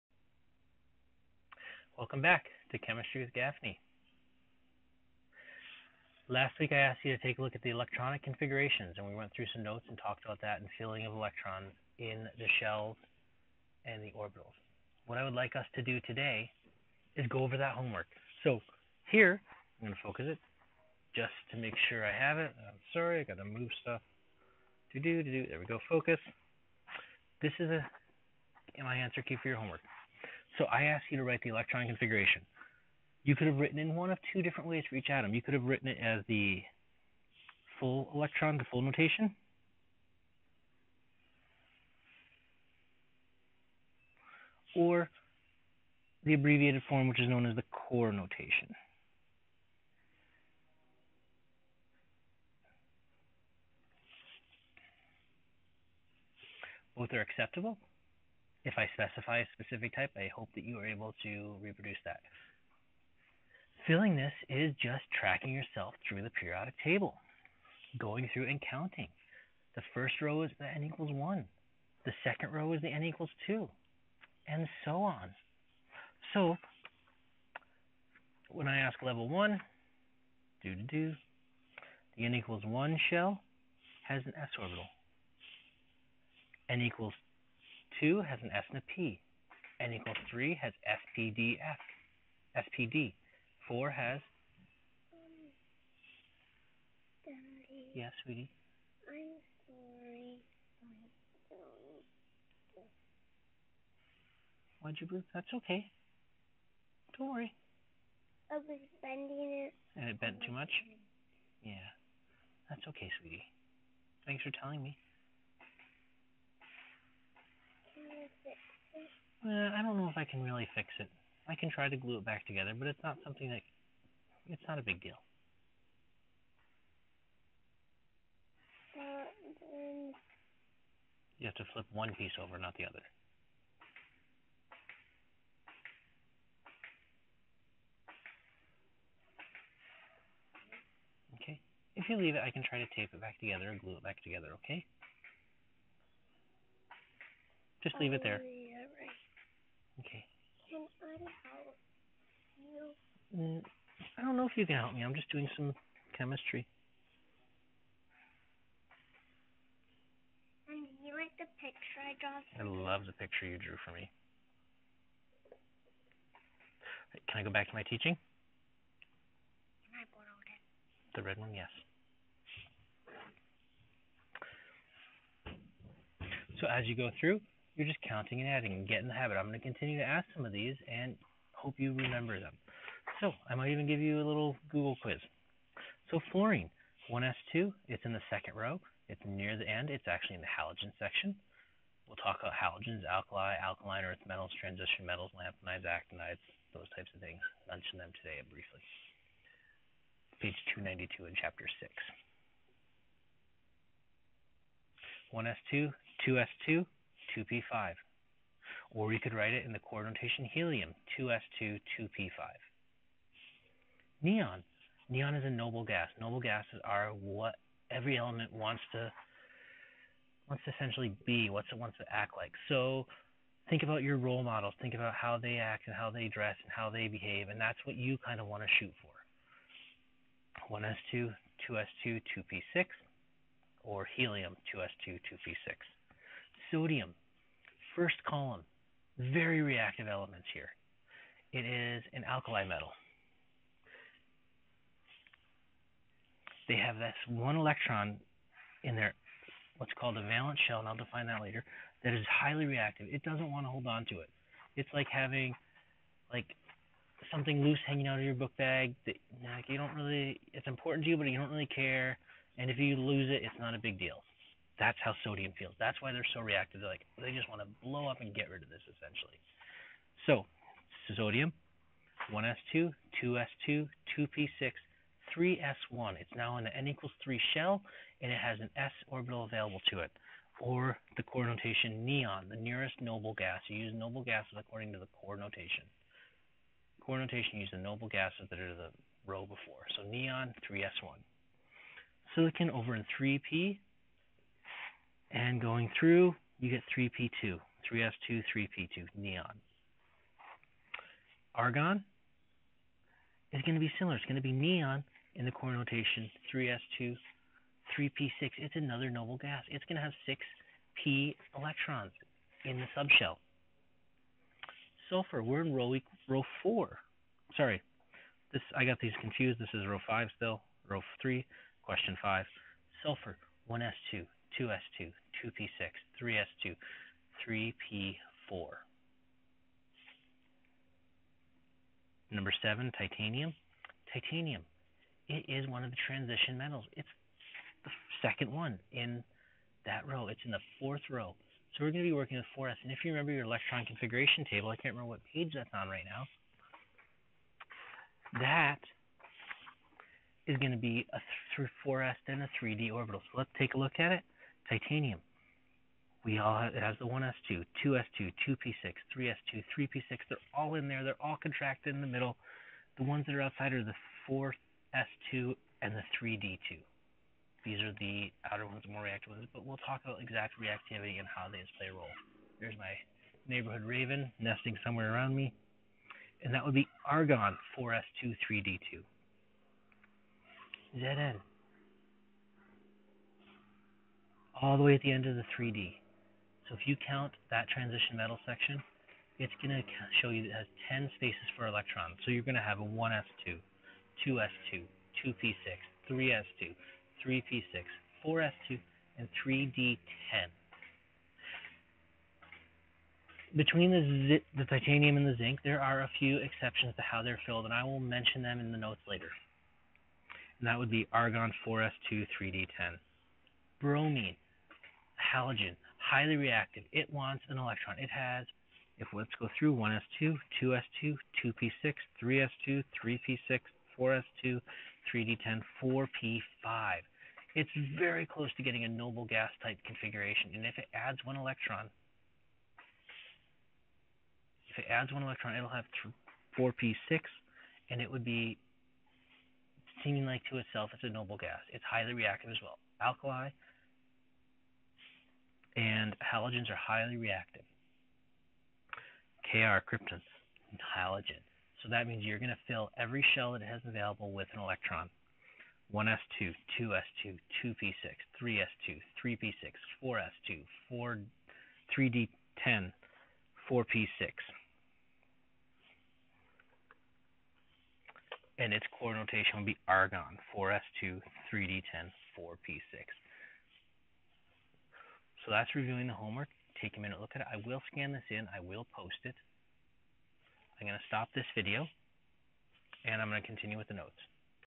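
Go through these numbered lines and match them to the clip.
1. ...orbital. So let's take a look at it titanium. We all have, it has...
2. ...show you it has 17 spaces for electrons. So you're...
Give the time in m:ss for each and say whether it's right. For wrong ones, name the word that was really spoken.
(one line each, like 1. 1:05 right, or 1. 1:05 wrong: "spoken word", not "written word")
1. 5:52 right
2. 6:30 wrong: "10", not "17".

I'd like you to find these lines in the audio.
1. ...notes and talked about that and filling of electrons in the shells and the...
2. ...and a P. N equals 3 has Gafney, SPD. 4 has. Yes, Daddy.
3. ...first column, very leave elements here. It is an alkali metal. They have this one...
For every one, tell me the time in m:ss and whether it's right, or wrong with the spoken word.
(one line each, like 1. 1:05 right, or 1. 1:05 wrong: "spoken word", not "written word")
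1. 0:09 right
2. 1:28 wrong: "SPDF", not "Gafney"
3. 3:57 wrong: "reactive", not "leave".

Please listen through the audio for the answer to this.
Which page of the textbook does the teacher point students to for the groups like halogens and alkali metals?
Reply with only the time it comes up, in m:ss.
3:20.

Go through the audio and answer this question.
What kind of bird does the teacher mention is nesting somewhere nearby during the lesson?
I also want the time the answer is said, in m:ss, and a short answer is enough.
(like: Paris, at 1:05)
raven, at 6:13.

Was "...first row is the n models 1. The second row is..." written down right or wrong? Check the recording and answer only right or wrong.
wrong.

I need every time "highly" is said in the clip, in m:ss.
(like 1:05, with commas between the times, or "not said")
4:12, 6:55, 7:21, 7:26.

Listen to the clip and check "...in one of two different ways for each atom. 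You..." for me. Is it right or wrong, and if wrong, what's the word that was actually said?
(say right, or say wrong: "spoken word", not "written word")
right.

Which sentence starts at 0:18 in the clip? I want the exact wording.
So here, I'm going to focus it just to make sure I have it.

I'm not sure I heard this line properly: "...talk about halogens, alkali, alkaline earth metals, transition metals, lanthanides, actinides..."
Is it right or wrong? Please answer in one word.
right.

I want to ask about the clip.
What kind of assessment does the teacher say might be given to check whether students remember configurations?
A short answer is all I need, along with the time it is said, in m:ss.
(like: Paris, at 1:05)
Google quiz, at 3:04.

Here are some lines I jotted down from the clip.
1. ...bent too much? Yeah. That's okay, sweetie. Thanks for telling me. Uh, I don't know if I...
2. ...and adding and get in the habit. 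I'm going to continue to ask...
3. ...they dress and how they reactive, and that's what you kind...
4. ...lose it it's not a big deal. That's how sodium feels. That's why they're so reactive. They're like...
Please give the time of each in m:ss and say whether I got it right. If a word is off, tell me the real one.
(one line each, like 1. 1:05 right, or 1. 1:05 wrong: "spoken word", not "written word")
1. 1:50 right
2. 2:58 right
3. 3:46 wrong: "behave", not "reactive"
4. 4:22 right.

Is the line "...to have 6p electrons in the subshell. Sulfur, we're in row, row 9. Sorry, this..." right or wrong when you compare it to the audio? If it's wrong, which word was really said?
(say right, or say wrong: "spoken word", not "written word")
wrong: "4", not "9".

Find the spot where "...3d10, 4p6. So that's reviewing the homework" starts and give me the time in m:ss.
7:51.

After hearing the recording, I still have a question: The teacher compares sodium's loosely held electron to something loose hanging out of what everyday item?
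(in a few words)
book bag.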